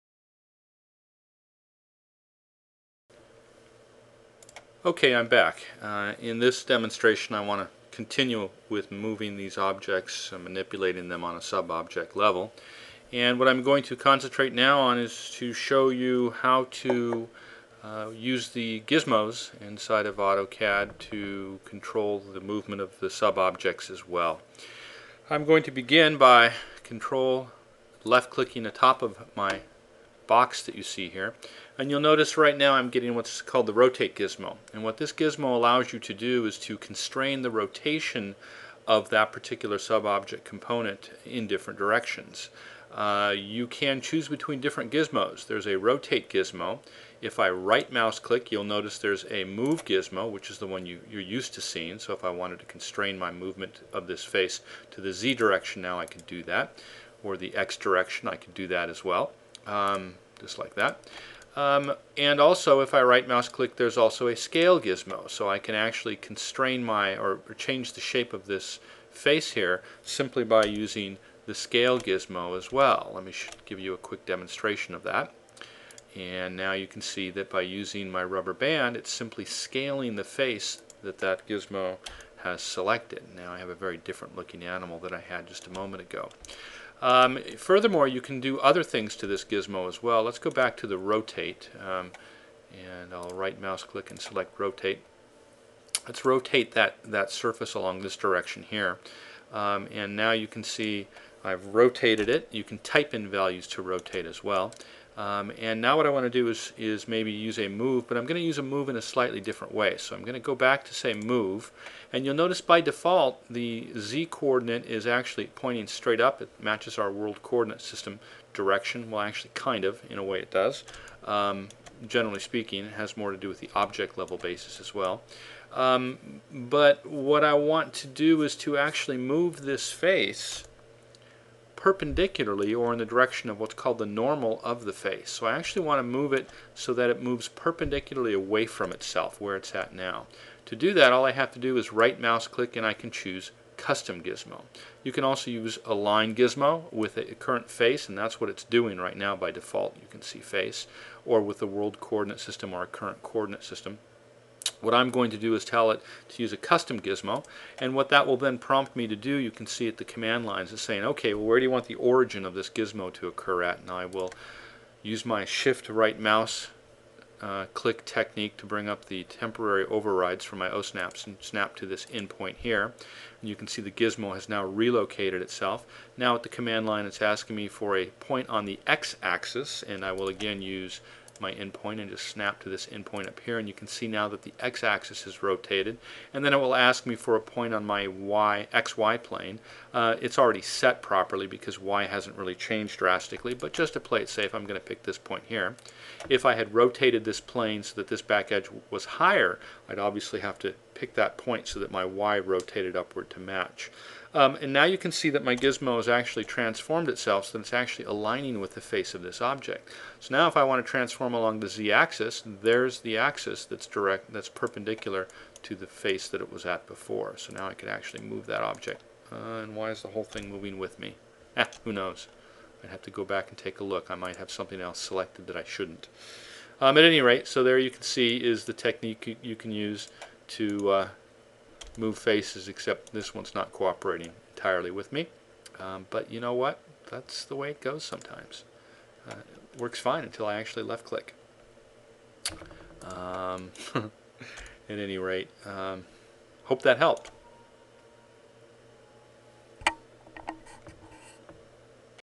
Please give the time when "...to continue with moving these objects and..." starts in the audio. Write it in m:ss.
0:07.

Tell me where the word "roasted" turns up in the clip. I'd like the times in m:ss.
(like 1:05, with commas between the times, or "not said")
not said.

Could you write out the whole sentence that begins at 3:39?
Uh, and why is the whole thing moving with me?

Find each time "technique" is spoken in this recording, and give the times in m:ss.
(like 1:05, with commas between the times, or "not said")
2:48, 3:48.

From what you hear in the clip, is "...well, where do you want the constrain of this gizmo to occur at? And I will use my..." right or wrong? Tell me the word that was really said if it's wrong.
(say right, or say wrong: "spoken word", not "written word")
wrong: "origin", not "constrain".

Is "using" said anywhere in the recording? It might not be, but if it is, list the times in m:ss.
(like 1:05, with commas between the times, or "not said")
1:10, 1:17.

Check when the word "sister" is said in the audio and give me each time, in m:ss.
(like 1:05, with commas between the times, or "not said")
not said.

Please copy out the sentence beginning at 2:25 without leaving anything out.
You can also use align gizmo with a current face and that's what it's doing right now by default.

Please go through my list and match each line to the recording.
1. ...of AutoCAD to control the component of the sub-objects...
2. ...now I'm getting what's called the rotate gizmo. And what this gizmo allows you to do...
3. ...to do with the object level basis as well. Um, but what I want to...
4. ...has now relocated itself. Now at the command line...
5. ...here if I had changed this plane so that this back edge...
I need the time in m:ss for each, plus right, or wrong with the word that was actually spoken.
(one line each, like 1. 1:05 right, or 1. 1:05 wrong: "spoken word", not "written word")
1. 0:20 wrong: "movement", not "component"
2. 0:32 right
3. 2:03 right
4. 2:54 right
5. 3:15 wrong: "rotated", not "changed".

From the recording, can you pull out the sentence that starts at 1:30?
Let's go back to the rotate, um, and I'll right mouse click and select rotate.